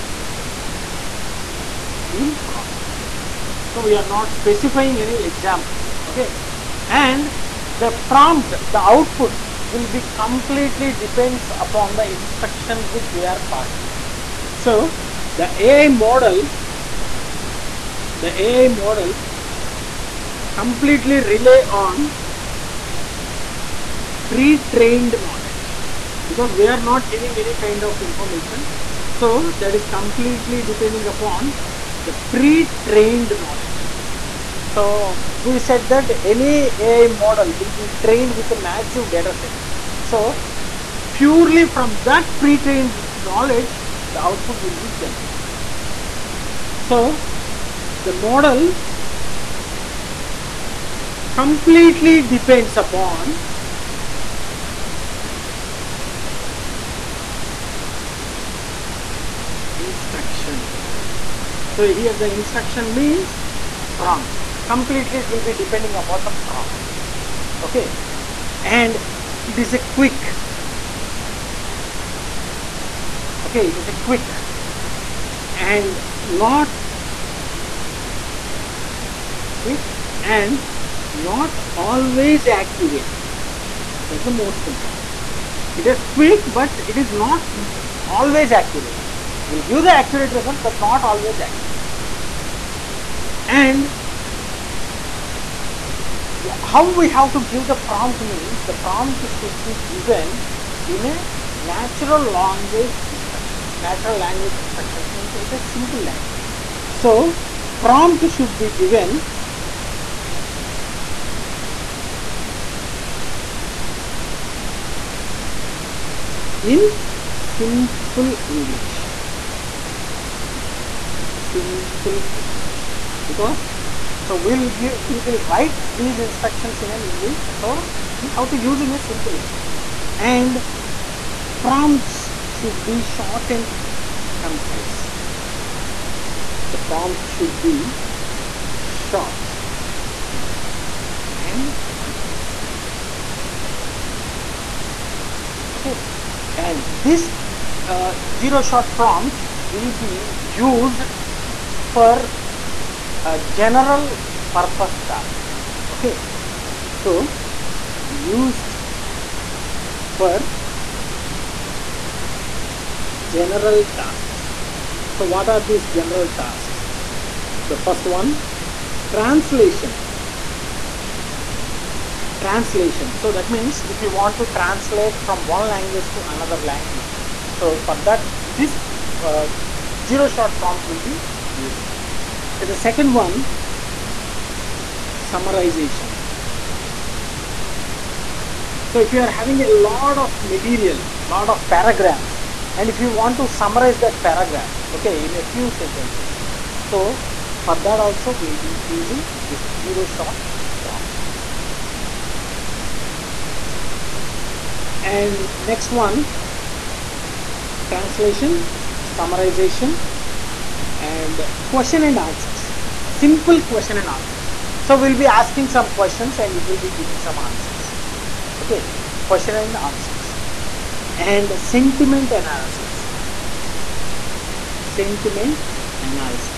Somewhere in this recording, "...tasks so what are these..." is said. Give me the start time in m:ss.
2:43.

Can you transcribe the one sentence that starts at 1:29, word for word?
It will give the accurate result, but not always accurate.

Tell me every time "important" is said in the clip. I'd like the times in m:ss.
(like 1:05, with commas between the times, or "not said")
1:24.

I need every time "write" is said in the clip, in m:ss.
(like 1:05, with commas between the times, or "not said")
2:05.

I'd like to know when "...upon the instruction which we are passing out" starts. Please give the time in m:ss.
0:11.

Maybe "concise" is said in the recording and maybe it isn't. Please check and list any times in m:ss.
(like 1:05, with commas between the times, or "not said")
2:14, 2:21.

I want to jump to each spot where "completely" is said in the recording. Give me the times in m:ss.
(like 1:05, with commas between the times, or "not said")
0:10, 0:20, 0:29, 0:51, 1:04.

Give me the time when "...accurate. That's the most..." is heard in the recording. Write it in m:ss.
1:22.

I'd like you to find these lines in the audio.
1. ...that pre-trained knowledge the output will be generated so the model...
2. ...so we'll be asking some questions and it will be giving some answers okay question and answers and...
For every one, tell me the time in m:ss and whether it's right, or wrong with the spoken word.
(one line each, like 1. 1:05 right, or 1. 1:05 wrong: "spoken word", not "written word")
1. 0:42 right
2. 3:34 right.